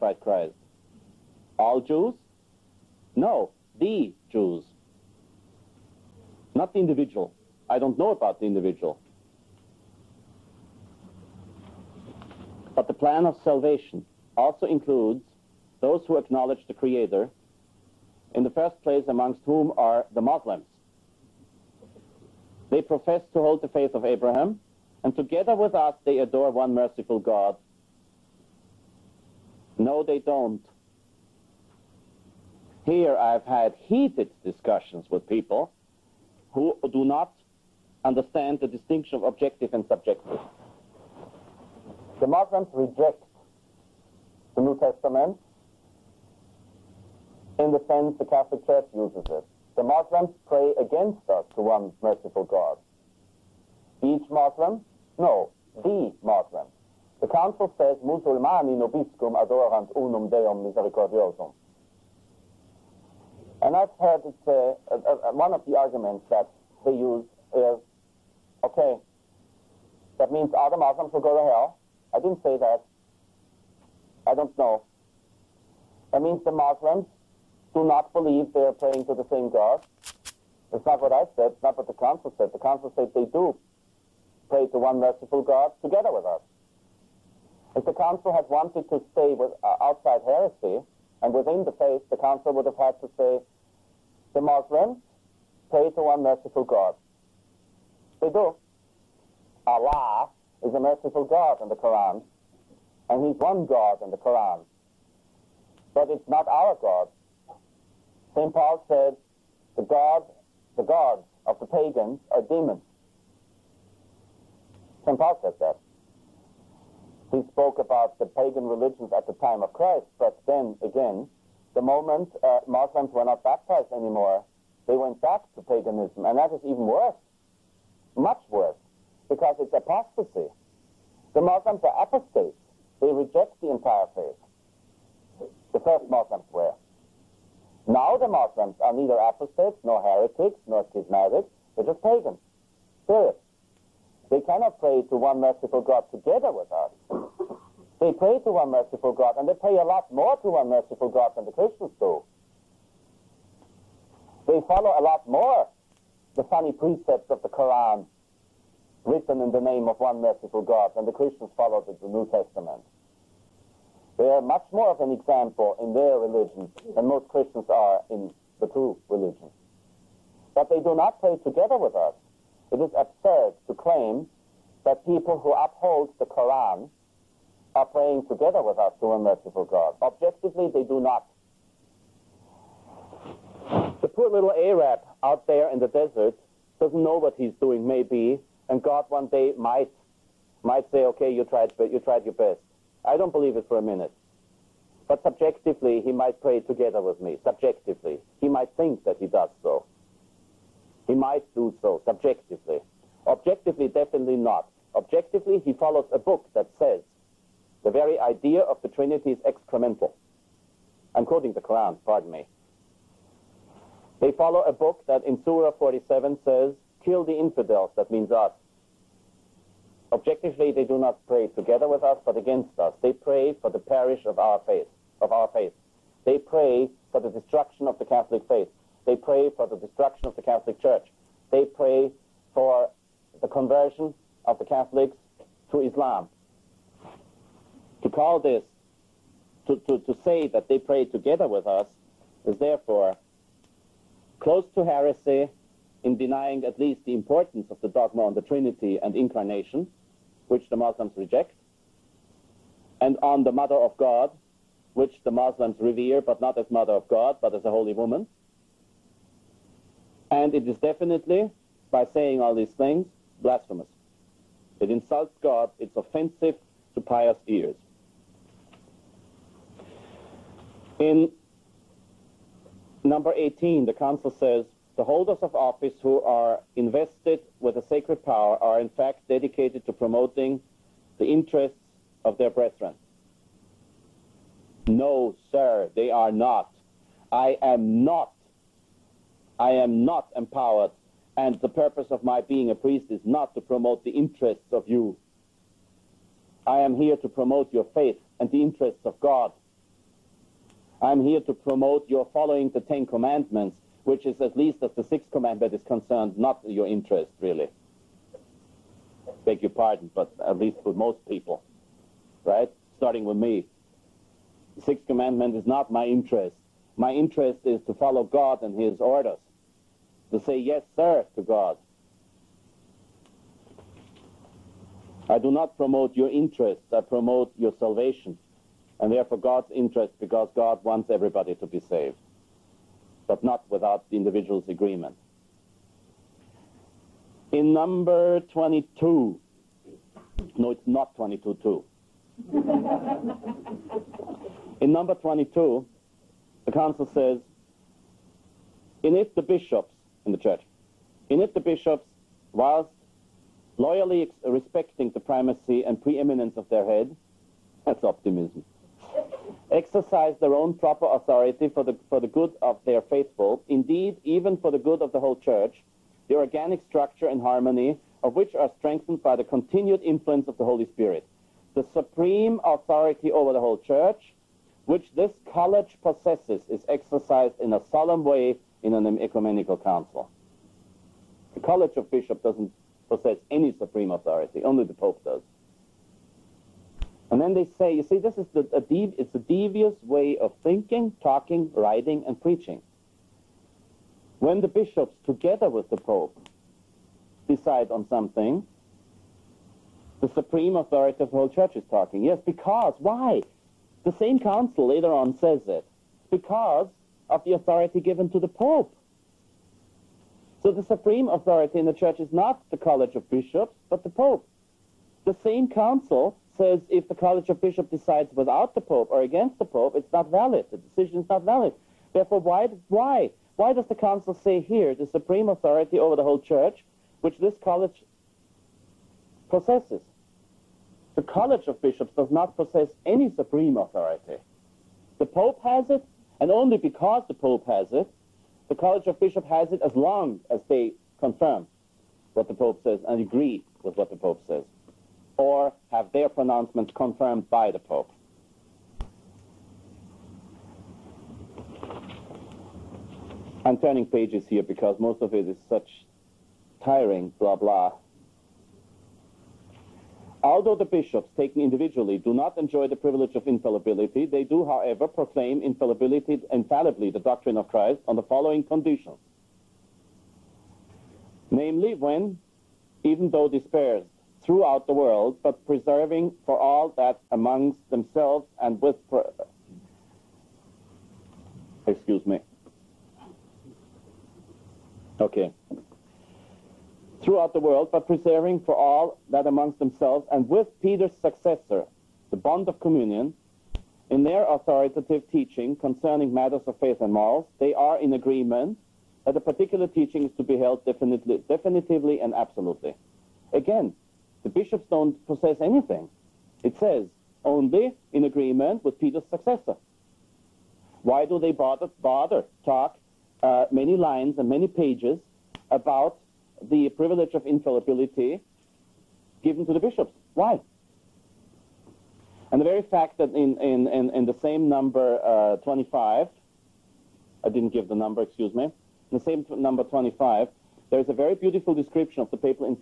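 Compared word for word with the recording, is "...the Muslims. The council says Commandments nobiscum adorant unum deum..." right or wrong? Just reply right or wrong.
wrong.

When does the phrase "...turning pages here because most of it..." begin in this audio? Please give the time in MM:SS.
07:33.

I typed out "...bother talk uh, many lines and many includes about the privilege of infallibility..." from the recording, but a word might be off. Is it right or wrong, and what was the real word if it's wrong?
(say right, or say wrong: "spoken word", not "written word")
wrong: "pages", not "includes".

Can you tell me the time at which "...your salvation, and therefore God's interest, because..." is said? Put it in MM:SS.
05:27.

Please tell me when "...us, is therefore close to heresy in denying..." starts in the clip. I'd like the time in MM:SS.
04:01.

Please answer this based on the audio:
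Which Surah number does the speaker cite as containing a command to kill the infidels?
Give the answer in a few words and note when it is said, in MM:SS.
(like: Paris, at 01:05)
47, at 03:35.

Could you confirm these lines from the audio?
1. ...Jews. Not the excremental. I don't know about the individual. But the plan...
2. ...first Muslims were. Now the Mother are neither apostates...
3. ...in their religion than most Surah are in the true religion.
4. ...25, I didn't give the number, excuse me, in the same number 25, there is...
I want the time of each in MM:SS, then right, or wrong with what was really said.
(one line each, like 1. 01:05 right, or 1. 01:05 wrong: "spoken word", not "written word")
1. 00:04 wrong: "individual", not "excremental"
2. 02:15 wrong: "Muslims", not "Mother"
3. 02:45 wrong: "Christians", not "Surah"
4. 08:45 right.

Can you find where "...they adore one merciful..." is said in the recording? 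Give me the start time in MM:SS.
00:26.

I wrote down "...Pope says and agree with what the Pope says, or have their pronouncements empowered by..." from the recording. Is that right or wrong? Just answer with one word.
wrong.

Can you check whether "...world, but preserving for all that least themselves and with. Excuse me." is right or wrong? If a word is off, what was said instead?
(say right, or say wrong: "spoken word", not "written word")
wrong: "amongst", not "least".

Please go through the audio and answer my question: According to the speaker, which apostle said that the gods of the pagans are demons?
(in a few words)
St. Paul.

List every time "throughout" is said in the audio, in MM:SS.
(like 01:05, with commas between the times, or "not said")
07:54, 08:07.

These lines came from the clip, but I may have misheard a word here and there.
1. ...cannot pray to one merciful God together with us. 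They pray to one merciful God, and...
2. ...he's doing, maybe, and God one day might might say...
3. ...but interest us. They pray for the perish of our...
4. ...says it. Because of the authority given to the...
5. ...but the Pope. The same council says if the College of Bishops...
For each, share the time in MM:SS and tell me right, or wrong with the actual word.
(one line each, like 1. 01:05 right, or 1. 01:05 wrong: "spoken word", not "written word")
1. 02:24 right
2. 03:07 right
3. 03:42 wrong: "against", not "interest"
4. 06:45 right
5. 06:53 right.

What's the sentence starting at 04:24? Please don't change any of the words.
It insults God, it's offensive to pious ears.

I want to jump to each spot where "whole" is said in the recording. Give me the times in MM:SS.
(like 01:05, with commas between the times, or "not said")
06:05, 06:13, 06:41, 07:06.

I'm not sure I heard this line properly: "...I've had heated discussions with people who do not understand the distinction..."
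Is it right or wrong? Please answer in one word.
right.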